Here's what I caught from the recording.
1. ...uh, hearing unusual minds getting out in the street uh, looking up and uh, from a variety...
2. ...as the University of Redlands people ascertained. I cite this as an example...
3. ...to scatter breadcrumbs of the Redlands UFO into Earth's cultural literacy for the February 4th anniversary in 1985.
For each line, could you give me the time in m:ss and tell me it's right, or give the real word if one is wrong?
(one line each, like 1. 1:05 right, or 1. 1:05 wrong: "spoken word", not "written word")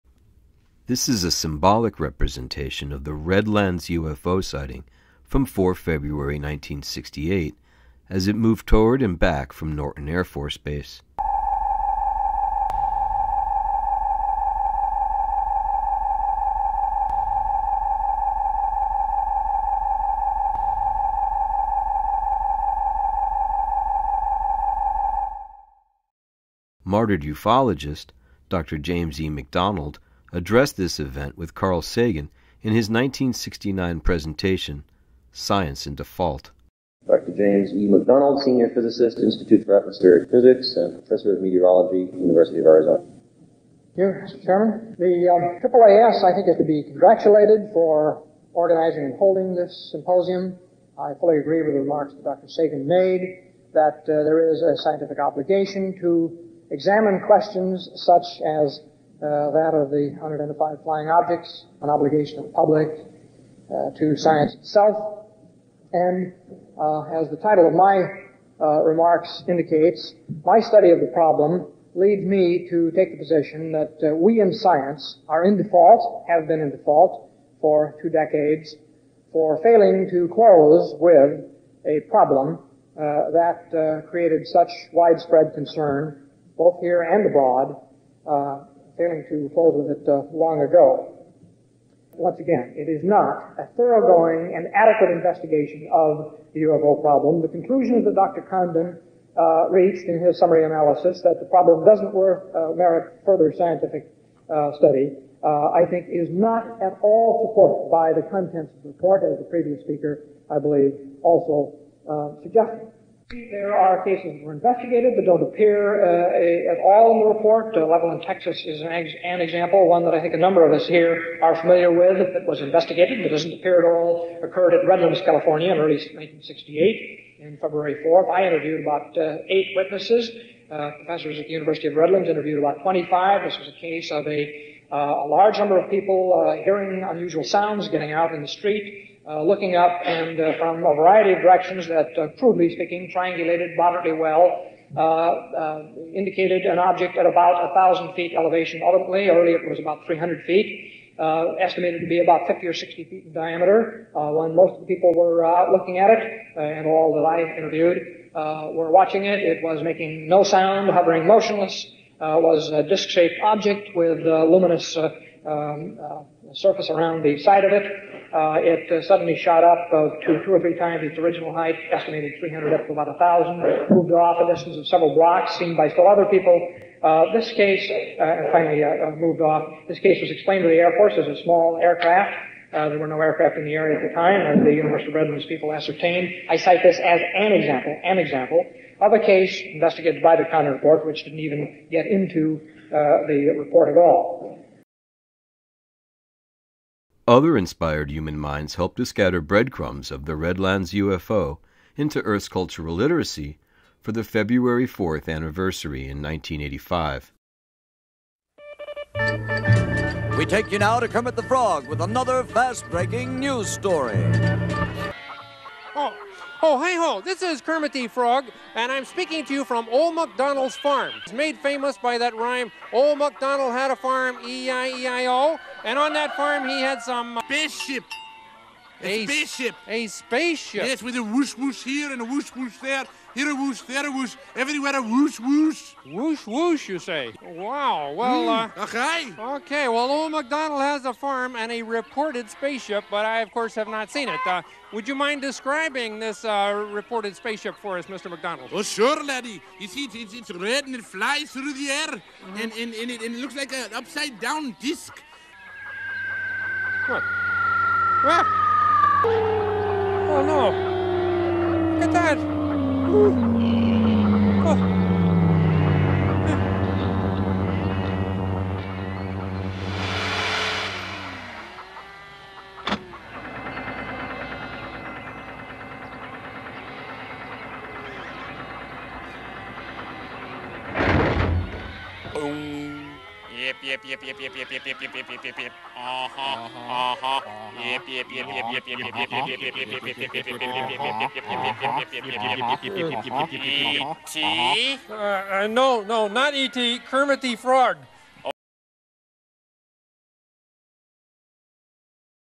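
1. 2:16 wrong: "sounds", not "minds"
2. 3:04 right
3. 3:18 right.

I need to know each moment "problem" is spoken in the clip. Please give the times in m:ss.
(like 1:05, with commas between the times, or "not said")
1:11, 1:22, 1:37, 1:41.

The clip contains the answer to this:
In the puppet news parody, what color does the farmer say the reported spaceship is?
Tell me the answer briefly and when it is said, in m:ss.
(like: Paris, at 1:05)
Red, at 4:10.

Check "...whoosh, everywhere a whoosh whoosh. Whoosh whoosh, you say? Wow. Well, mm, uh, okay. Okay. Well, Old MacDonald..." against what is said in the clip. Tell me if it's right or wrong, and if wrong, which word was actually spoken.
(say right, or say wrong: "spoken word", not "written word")
right.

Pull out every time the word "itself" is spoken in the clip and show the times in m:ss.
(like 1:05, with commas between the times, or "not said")
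1:04.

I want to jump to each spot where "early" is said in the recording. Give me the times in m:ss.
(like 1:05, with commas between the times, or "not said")
2:05, 2:29.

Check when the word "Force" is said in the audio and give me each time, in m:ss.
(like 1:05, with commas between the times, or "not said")
0:10, 3:00.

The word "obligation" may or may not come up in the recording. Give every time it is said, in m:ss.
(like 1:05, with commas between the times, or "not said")
0:55, 1:01.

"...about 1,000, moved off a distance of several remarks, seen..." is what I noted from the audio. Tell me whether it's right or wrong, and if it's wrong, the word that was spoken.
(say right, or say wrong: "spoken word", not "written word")
wrong: "blocks", not "remarks".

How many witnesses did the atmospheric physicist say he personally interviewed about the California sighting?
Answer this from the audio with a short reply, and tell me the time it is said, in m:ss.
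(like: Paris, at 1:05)
8, at 2:09.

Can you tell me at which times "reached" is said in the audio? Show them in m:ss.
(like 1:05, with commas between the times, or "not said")
1:39.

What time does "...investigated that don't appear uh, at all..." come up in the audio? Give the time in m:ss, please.
1:54.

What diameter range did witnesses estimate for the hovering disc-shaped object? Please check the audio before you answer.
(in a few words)
50 or 60 feet.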